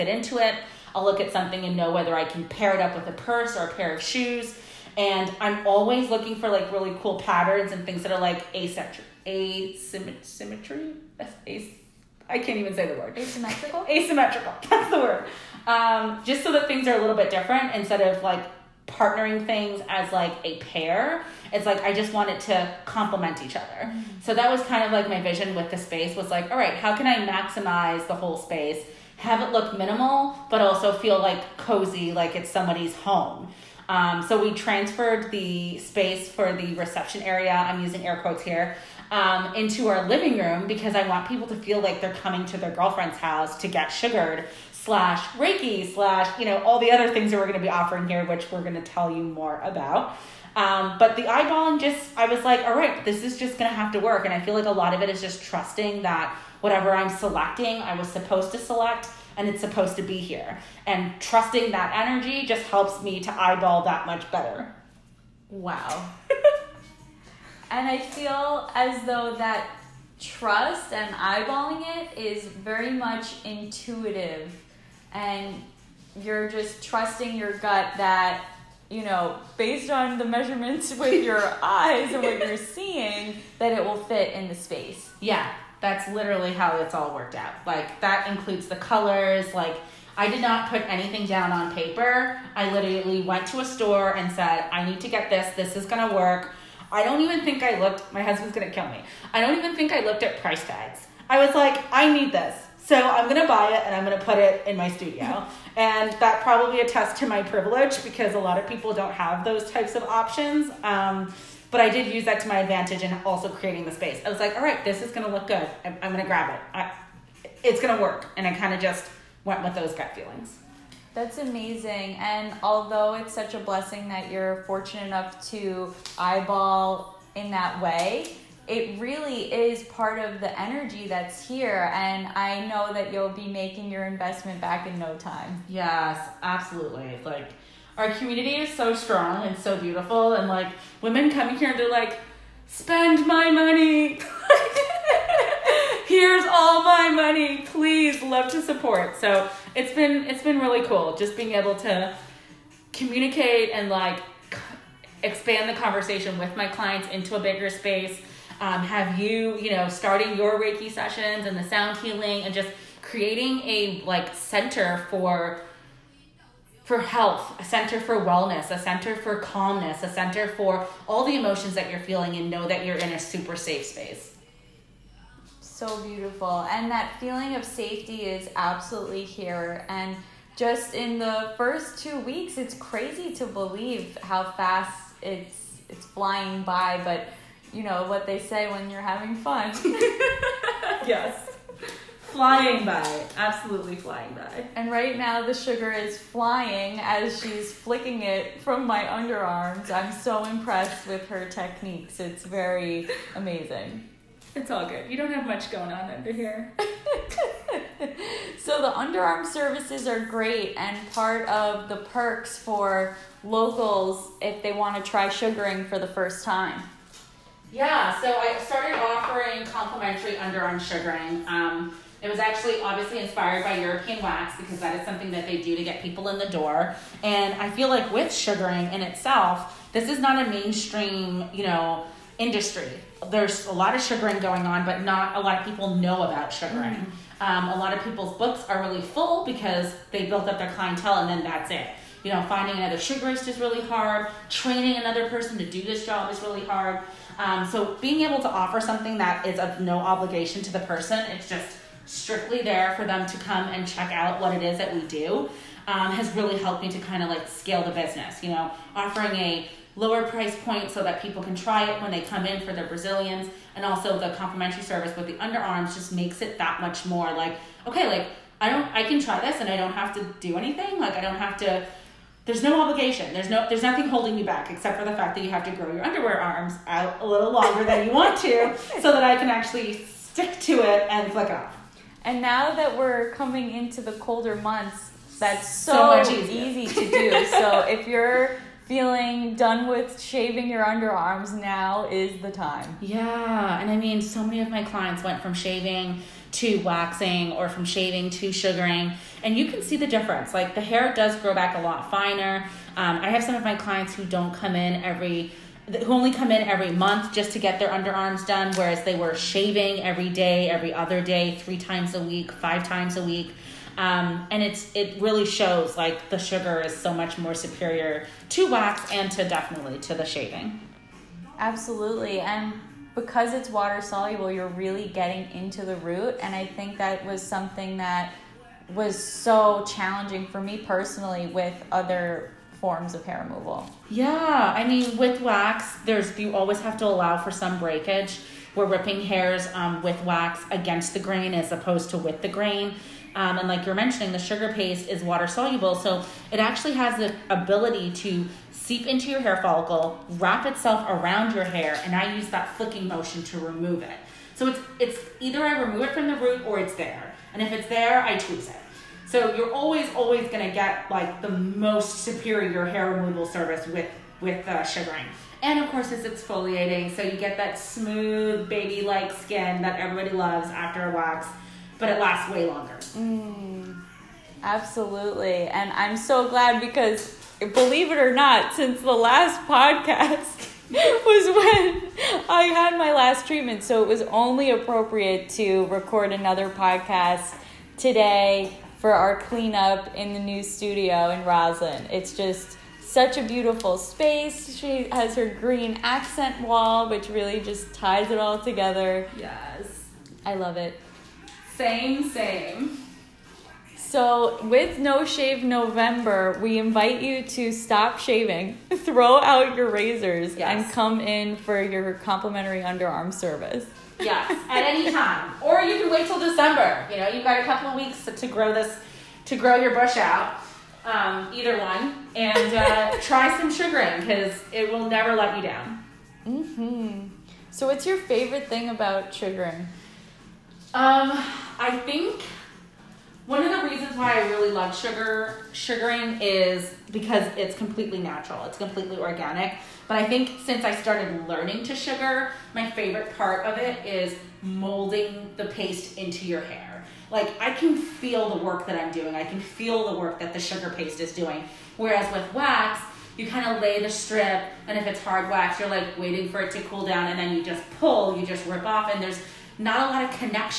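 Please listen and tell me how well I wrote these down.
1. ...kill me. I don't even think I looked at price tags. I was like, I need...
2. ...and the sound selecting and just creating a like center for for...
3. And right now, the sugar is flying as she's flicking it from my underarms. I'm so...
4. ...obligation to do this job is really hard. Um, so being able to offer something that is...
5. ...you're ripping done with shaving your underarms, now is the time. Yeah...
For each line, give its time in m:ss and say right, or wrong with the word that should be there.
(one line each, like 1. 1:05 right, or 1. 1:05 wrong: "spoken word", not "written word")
1. 1:38 right
2. 2:41 wrong: "healing", not "selecting"
3. 3:14 right
4. 4:05 wrong: "person", not "obligation"
5. 4:48 wrong: "feeling", not "ripping".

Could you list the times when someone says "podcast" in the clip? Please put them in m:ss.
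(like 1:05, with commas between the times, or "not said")
6:19, 6:26.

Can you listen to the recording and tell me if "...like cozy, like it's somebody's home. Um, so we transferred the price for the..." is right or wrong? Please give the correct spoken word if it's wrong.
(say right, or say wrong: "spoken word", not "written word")
wrong: "space", not "price".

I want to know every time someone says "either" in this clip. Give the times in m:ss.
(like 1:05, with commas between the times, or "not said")
5:55, 7:01.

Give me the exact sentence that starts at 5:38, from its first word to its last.
We're ripping hairs um, with wax against the grain as opposed to with the grain.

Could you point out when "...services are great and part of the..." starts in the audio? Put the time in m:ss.
3:29.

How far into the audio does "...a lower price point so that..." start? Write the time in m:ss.
4:19.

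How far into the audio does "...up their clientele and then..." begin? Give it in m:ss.
4:00.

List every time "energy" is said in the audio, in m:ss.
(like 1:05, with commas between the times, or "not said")
1:01, 2:10.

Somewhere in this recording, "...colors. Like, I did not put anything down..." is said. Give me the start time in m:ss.
1:28.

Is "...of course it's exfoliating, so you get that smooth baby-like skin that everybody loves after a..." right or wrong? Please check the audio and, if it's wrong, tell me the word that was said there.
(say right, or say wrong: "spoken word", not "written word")
right.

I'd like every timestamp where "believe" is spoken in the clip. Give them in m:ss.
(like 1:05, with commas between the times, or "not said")
3:03, 6:17.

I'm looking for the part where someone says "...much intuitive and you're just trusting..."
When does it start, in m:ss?
1:12.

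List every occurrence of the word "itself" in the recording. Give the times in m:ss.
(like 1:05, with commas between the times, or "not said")
3:48, 5:50.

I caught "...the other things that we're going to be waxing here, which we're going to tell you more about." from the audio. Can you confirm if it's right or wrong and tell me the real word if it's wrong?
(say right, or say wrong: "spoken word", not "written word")
wrong: "offering", not "waxing".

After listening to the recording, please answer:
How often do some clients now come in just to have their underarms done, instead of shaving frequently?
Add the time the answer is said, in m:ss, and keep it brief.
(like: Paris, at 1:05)
Every month, at 5:06.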